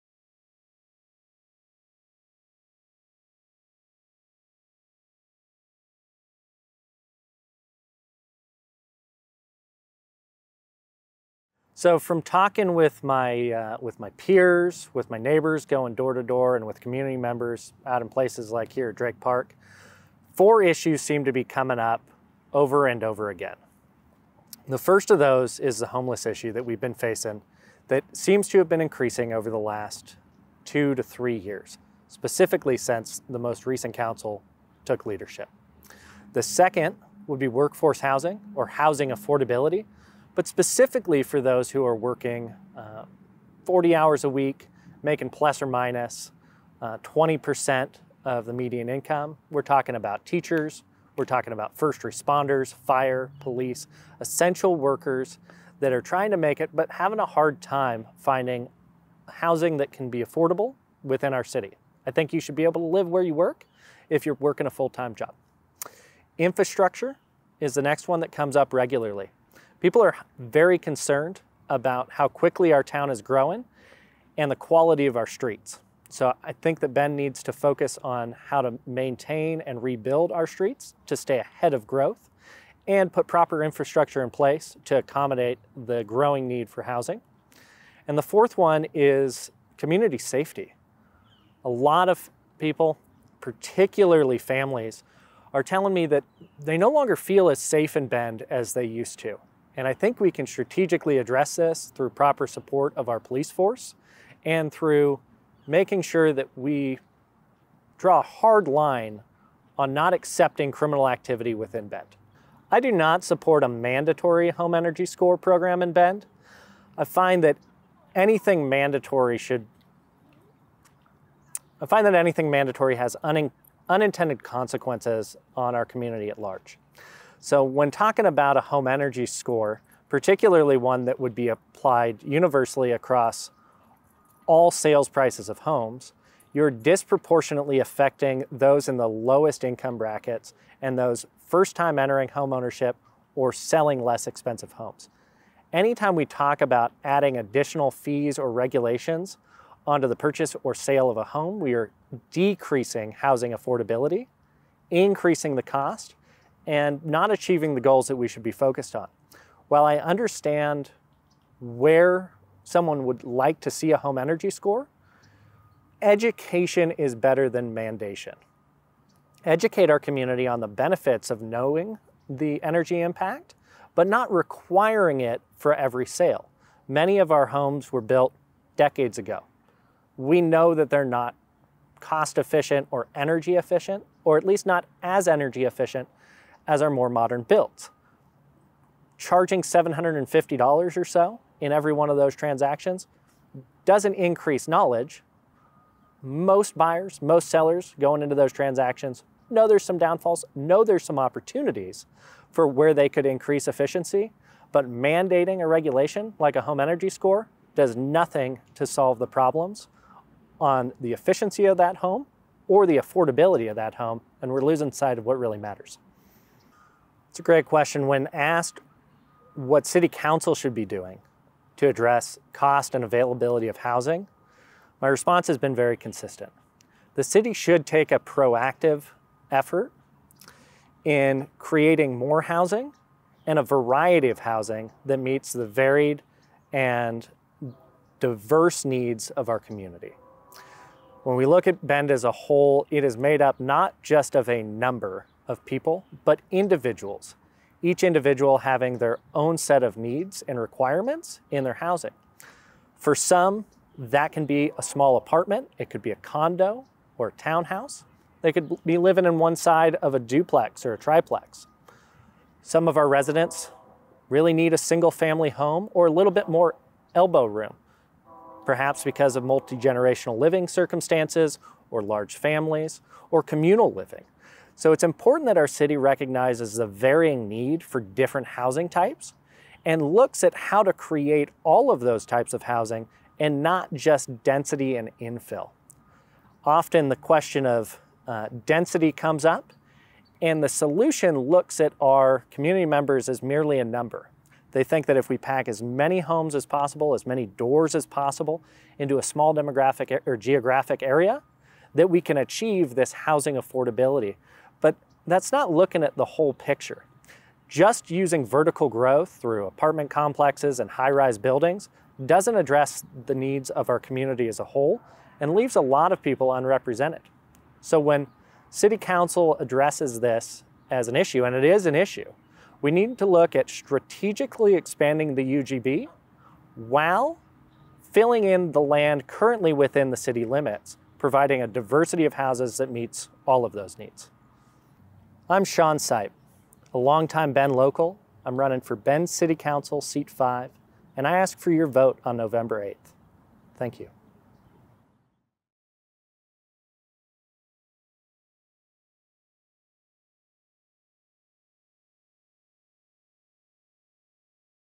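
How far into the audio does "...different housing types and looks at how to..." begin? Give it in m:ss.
4:38.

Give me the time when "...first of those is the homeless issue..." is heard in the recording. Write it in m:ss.
0:24.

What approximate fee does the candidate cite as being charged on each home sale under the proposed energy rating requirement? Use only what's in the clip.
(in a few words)
$750.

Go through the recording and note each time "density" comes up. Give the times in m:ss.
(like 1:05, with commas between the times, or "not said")
4:44, 4:48.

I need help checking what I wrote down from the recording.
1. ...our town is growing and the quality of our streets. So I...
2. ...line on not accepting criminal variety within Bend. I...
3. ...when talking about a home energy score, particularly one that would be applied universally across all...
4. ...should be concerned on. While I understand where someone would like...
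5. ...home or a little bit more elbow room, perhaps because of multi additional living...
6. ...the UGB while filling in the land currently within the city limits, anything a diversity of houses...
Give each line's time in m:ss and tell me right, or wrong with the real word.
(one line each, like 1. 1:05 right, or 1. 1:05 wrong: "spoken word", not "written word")
1. 1:12 right
2. 1:48 wrong: "activity", not "variety"
3. 2:07 right
4. 2:38 wrong: "focused", not "concerned"
5. 4:25 wrong: "generational", not "additional"
6. 5:25 wrong: "providing", not "anything".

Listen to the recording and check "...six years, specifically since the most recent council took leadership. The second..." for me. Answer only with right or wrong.
wrong.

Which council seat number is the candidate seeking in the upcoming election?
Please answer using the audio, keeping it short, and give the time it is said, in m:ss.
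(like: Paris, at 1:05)
5, at 5:39.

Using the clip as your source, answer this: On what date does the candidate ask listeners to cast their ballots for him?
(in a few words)
November 8th.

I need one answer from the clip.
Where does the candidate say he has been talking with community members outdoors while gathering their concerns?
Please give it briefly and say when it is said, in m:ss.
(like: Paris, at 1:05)
Drake Park, at 0:18.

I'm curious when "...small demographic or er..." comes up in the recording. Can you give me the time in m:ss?
4:59.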